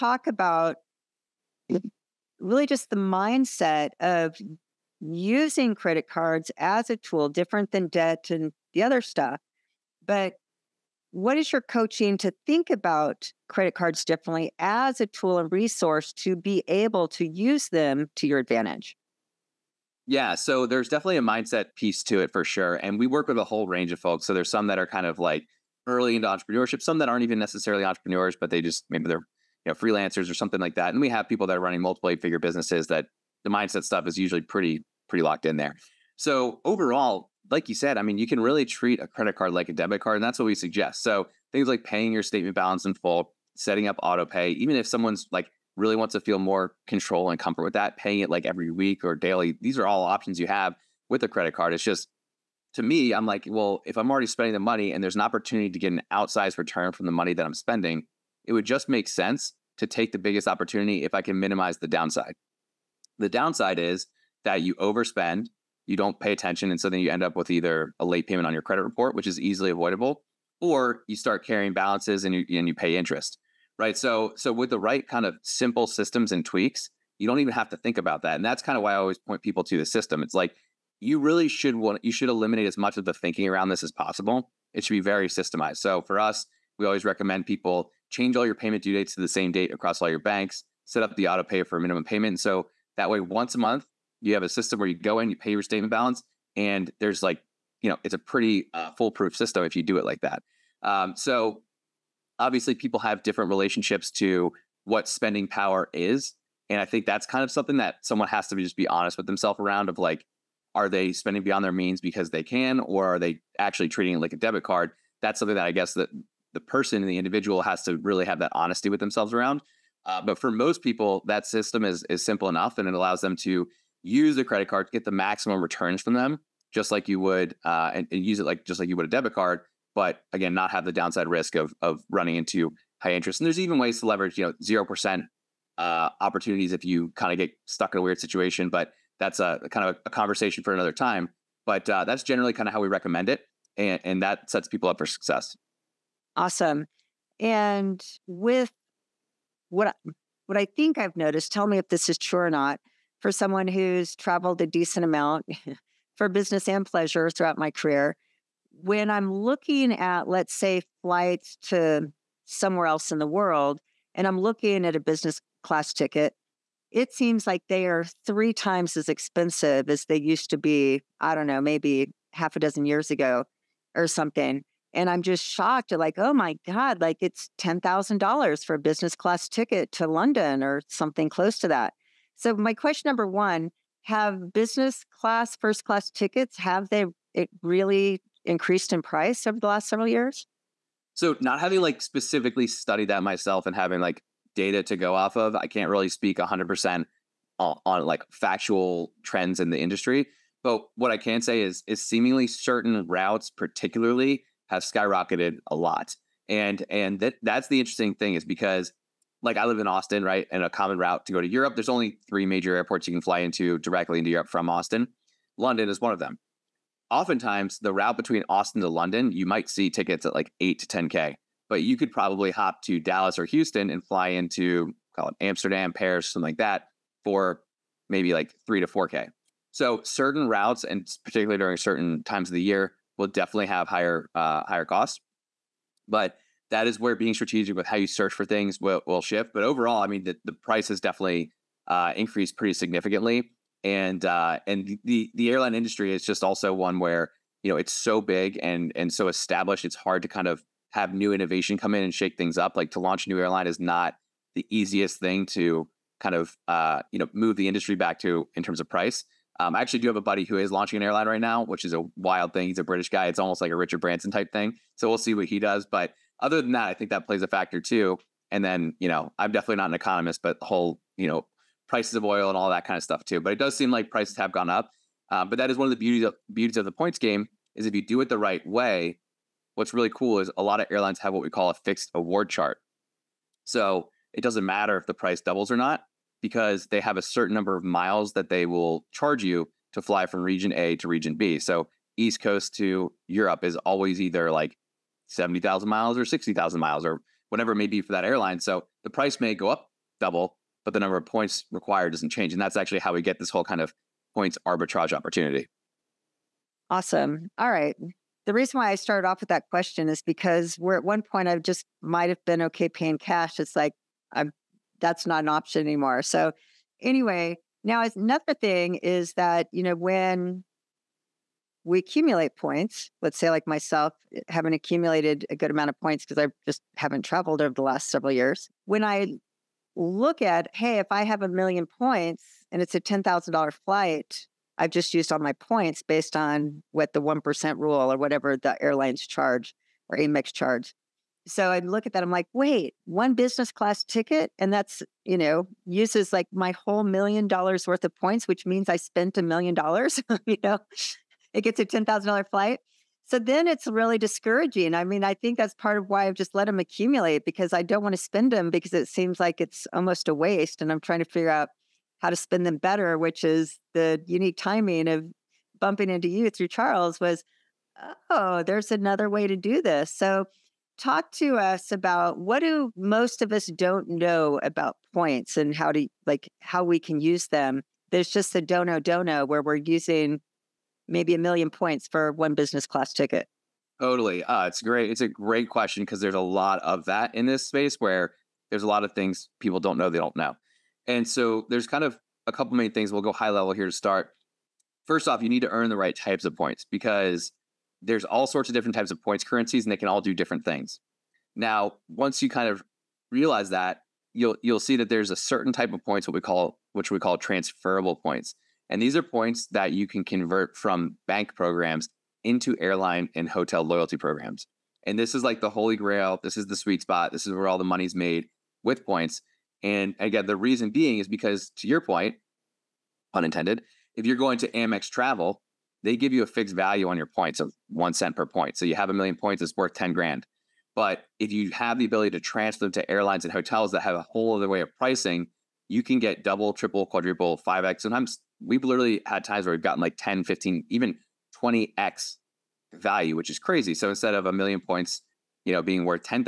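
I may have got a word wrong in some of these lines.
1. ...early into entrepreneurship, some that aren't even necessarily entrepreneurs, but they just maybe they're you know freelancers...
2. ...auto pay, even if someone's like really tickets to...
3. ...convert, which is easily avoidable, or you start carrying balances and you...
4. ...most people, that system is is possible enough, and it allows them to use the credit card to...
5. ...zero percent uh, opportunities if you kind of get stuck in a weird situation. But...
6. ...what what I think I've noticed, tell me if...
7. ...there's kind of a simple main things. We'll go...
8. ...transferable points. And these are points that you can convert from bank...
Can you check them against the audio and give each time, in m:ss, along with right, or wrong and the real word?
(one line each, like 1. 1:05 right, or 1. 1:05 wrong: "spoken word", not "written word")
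1. 0:25 right
2. 0:44 wrong: "wants", not "tickets"
3. 1:08 wrong: "report", not "convert"
4. 2:00 wrong: "simple", not "possible"
5. 2:14 right
6. 2:29 right
7. 6:31 wrong: "couple", not "simple"
8. 6:47 right.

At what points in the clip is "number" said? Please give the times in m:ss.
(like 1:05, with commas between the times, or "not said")
3:03, 4:47, 5:01.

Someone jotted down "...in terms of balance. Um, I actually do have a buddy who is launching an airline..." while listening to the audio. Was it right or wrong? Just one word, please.
wrong.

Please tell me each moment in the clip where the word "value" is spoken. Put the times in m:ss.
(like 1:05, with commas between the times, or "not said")
7:06, 7:22.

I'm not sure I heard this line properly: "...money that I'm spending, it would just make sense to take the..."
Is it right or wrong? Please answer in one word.
right.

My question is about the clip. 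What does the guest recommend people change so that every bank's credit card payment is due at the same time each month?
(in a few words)
payment due dates.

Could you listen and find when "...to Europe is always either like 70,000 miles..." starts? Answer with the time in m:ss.
4:52.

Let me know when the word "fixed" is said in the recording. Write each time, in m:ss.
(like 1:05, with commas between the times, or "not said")
4:41, 7:06.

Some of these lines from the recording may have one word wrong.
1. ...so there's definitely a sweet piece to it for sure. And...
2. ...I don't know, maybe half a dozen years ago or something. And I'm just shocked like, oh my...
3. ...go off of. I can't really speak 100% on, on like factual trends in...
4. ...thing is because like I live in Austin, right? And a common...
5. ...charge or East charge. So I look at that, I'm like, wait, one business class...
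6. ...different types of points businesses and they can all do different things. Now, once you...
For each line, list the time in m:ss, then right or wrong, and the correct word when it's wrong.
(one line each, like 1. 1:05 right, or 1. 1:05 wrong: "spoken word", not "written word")
1. 0:20 wrong: "mindset", not "sweet"
2. 2:51 right
3. 3:14 right
4. 3:28 right
5. 5:39 wrong: "Amex", not "East"
6. 6:38 wrong: "currencies", not "businesses".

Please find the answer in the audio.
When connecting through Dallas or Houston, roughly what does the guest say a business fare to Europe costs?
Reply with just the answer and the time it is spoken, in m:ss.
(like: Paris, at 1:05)
3 to 4K, at 3:48.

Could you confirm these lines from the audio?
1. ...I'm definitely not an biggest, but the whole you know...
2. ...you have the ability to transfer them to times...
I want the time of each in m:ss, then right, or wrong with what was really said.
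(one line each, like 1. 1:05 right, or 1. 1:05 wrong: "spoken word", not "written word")
1. 4:29 wrong: "economist", not "biggest"
2. 7:11 wrong: "airlines", not "times".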